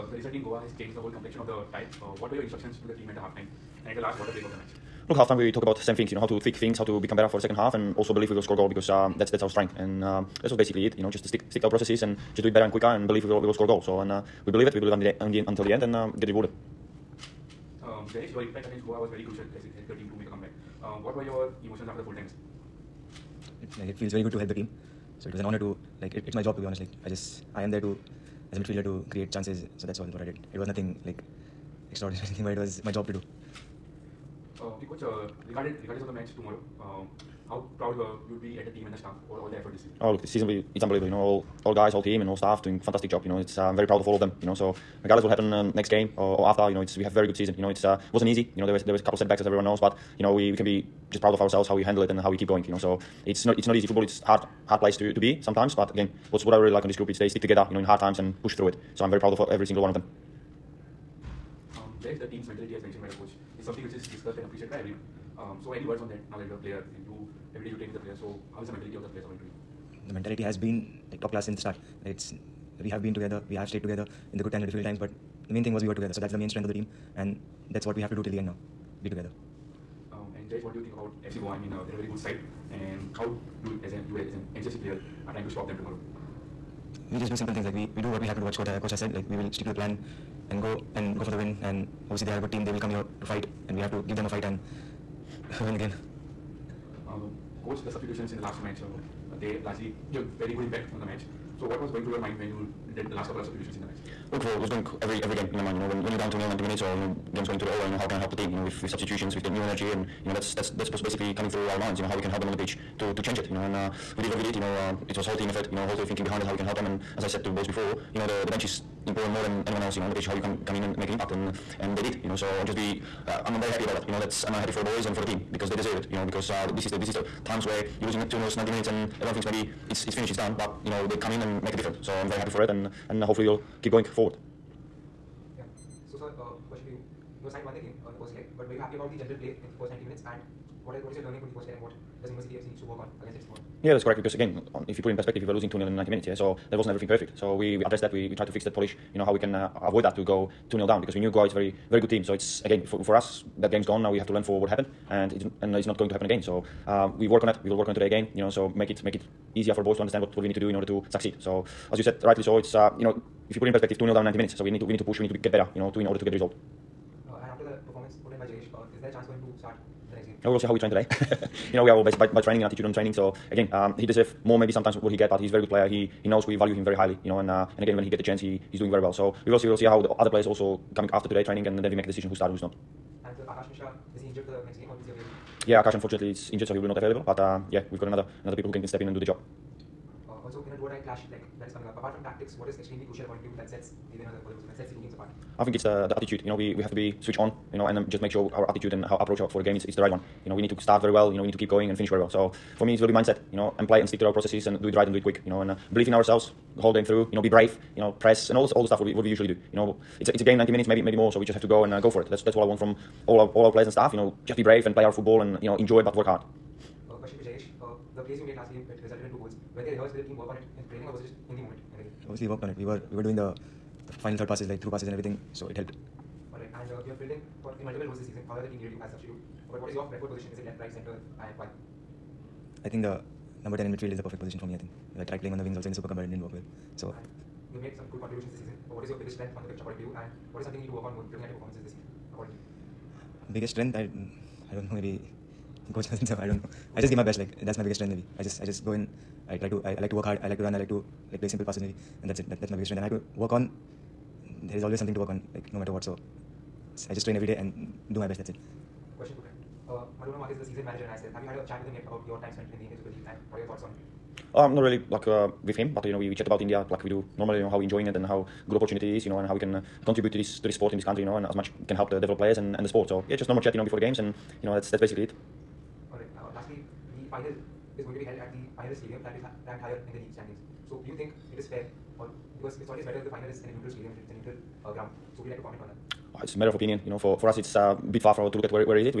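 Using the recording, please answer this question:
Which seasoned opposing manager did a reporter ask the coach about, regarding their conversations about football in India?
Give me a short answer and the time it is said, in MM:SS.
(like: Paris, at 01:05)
Manolo Marquez, at 04:20.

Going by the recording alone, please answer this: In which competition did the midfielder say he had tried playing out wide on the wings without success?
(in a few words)
Super Cup.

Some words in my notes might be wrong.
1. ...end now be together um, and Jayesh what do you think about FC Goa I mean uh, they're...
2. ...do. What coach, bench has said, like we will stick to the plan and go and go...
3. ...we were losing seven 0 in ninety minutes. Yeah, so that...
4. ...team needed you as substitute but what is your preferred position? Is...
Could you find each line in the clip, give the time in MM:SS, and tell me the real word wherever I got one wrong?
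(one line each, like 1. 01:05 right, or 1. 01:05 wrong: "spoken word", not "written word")
1. 01:18 right
2. 01:28 wrong: "coach", not "bench"
3. 02:25 wrong: "two", not "seven"
4. 03:48 right.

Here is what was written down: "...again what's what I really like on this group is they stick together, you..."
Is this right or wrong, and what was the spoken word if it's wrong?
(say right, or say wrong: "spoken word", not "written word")
right.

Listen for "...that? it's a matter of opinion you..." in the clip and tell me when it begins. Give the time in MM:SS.
04:45.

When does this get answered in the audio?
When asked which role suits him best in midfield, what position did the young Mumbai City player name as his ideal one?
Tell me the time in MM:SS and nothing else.
03:53.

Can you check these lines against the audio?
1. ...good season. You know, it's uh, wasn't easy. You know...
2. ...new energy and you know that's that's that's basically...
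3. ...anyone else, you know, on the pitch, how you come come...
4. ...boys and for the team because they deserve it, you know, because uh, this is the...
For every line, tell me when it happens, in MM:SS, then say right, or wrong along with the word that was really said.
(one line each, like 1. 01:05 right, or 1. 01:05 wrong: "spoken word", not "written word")
1. 00:47 right
2. 01:49 right
3. 01:59 right
4. 02:04 right.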